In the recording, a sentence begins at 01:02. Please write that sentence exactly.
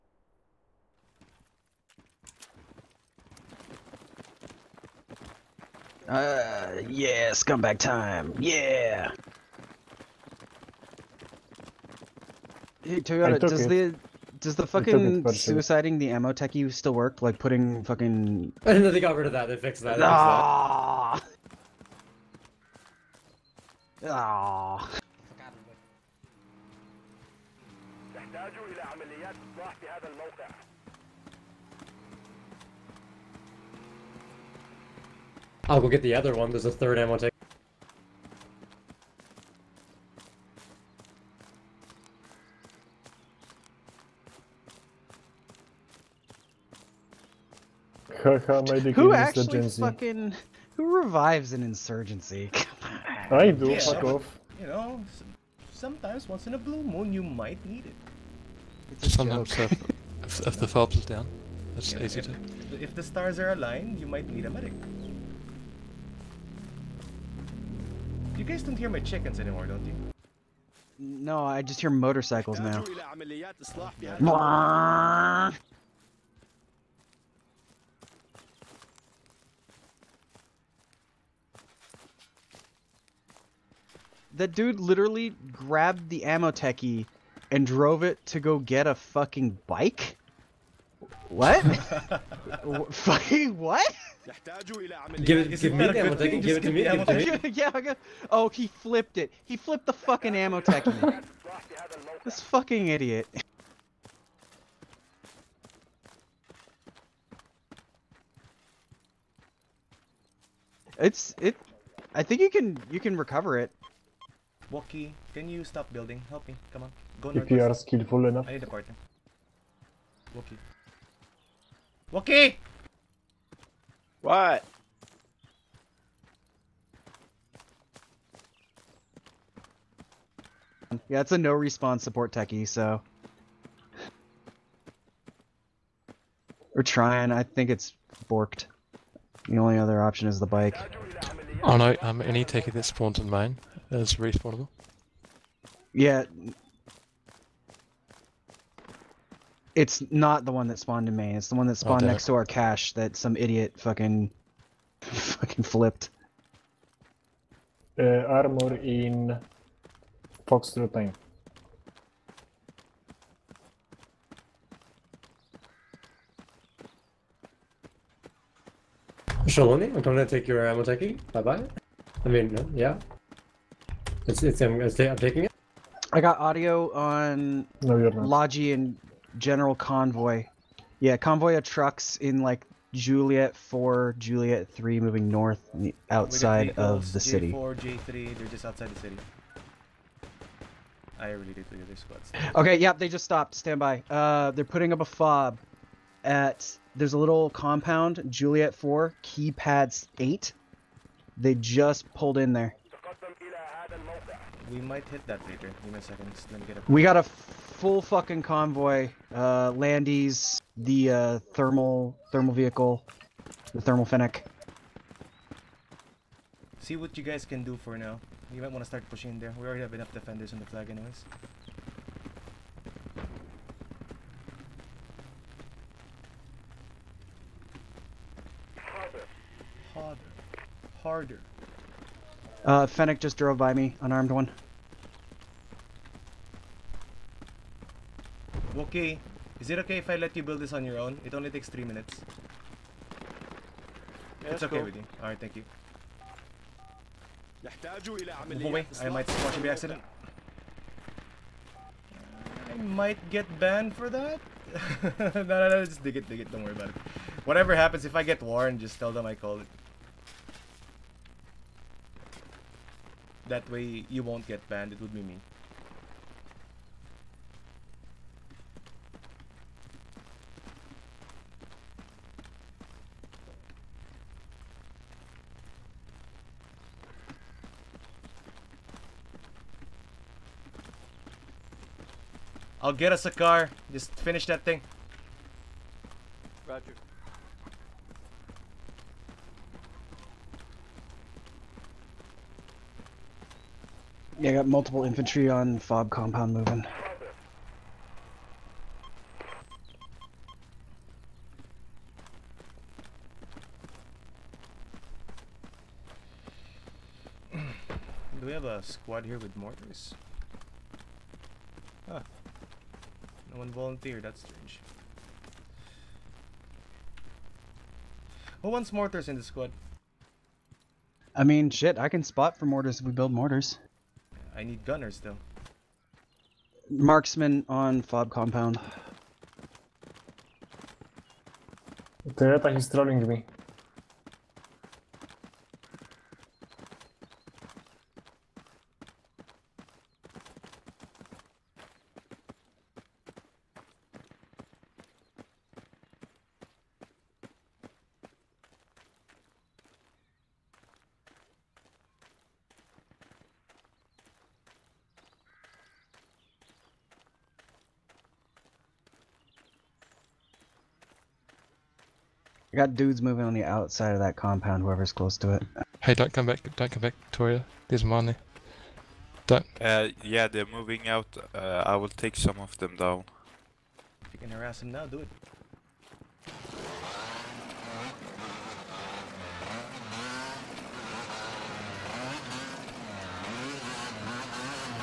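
If the stars are aligned, you might need a medic.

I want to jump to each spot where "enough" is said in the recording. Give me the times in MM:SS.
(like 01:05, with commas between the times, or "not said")
01:58, 03:39.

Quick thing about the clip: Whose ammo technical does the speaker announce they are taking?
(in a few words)
Shaloni.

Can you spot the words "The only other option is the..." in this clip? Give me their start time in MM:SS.
02:19.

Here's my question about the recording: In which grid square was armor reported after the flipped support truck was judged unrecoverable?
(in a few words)
Fox 9.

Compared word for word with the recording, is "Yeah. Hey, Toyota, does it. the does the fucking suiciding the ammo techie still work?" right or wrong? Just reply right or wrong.
right.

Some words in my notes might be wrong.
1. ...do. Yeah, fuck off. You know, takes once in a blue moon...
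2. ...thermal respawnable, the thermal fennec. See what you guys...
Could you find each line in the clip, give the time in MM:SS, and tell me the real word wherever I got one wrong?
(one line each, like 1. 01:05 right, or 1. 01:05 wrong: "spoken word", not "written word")
1. 00:53 wrong: "sometimes", not "takes"
2. 03:32 wrong: "vehicle", not "respawnable".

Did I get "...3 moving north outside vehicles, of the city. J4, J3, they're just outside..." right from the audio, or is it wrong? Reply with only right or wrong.
right.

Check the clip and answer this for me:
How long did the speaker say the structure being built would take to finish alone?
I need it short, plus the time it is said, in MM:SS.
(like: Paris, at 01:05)
3 minutes, at 04:01.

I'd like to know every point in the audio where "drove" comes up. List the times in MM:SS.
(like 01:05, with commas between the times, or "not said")
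01:27, 03:53.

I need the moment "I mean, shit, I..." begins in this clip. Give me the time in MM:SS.
05:21.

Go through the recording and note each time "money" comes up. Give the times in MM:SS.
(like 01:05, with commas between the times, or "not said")
06:08.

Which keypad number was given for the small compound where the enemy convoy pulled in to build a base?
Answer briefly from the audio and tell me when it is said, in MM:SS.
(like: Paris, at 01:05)
8, at 03:20.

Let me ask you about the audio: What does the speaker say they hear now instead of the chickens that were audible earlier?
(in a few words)
Motorcycles.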